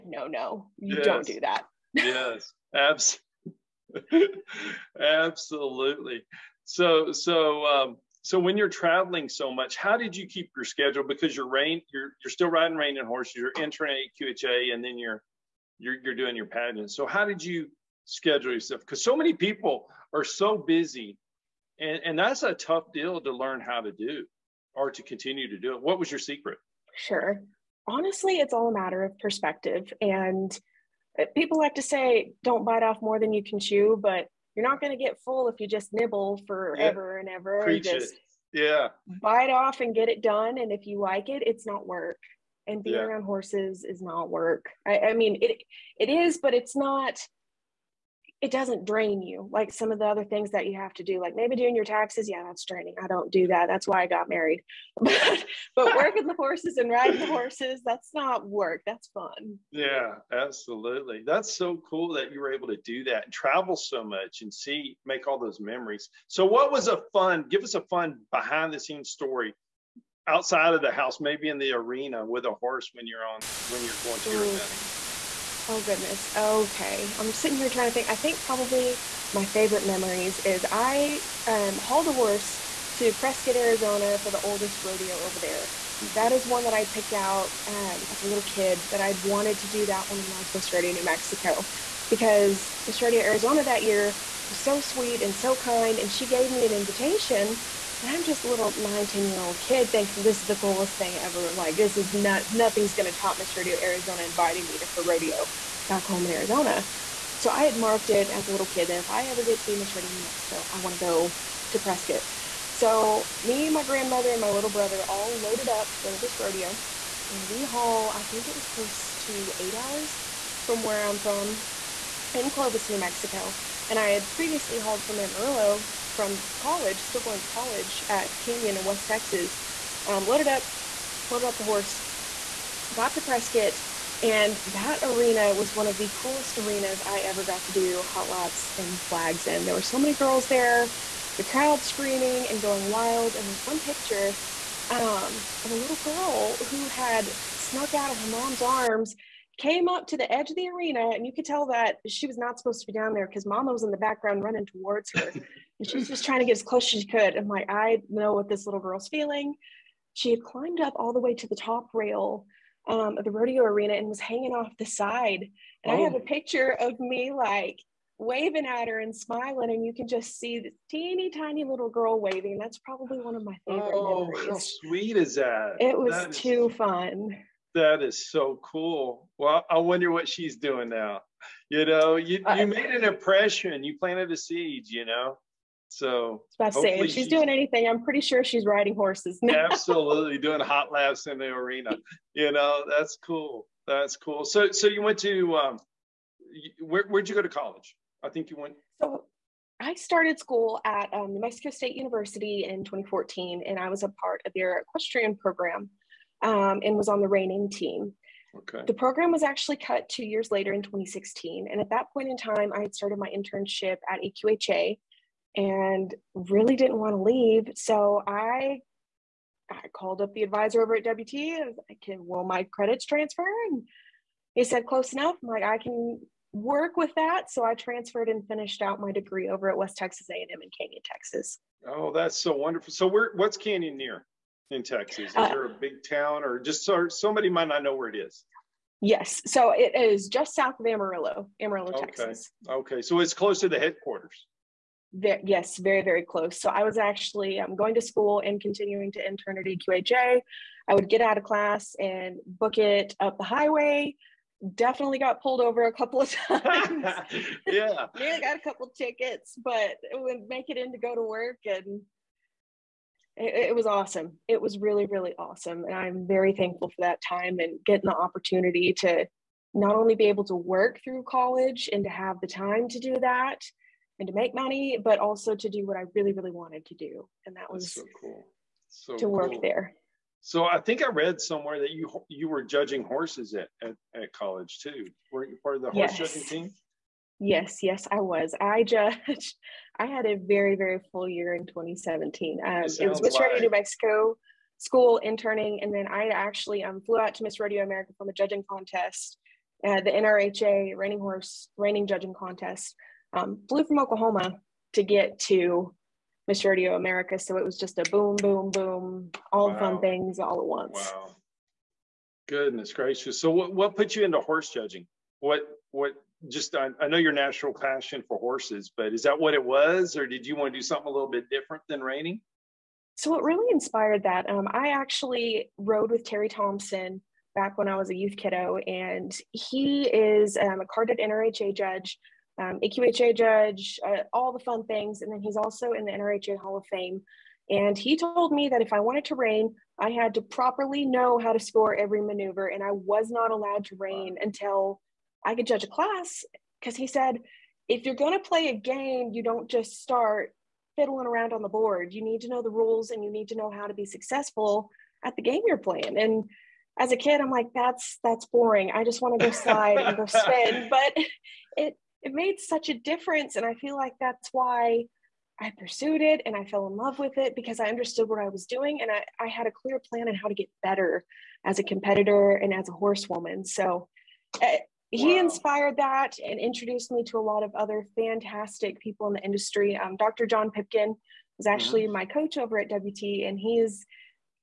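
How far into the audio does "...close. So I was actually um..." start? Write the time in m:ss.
4:06.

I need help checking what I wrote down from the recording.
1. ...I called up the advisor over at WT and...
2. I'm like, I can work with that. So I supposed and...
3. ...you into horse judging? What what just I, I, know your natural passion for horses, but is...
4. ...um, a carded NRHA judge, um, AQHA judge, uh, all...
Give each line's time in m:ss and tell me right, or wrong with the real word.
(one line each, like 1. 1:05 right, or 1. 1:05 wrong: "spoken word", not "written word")
1. 3:39 right
2. 3:45 wrong: "transferred", not "supposed"
3. 5:14 right
4. 5:30 right.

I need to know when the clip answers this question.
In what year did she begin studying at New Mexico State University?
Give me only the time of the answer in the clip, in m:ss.
3:22.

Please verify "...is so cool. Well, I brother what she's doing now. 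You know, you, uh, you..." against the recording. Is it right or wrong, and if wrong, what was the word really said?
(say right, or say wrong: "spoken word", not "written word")
wrong: "wonder", not "brother".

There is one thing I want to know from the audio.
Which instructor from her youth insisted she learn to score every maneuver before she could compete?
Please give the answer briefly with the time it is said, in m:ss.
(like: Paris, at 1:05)
Terry Thompson, at 5:26.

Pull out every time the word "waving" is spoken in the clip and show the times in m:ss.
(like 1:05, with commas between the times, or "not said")
2:48, 2:52.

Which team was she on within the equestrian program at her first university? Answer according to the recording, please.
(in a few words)
reining team.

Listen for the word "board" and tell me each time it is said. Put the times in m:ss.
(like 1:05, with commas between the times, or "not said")
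5:51.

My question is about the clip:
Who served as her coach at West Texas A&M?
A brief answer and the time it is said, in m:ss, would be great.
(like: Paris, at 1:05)
Dr. John Pipkin, at 6:20.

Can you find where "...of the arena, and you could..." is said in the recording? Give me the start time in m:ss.
2:30.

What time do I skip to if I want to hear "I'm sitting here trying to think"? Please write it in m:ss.
1:17.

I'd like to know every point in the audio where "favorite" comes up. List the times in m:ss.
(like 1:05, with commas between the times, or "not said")
1:19, 2:53.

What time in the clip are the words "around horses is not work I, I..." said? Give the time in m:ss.
0:43.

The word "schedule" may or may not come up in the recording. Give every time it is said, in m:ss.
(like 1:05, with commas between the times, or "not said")
0:10, 0:18.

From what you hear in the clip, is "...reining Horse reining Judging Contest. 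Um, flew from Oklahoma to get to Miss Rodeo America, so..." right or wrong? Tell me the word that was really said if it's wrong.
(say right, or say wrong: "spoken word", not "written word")
right.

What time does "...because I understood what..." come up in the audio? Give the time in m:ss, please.
6:07.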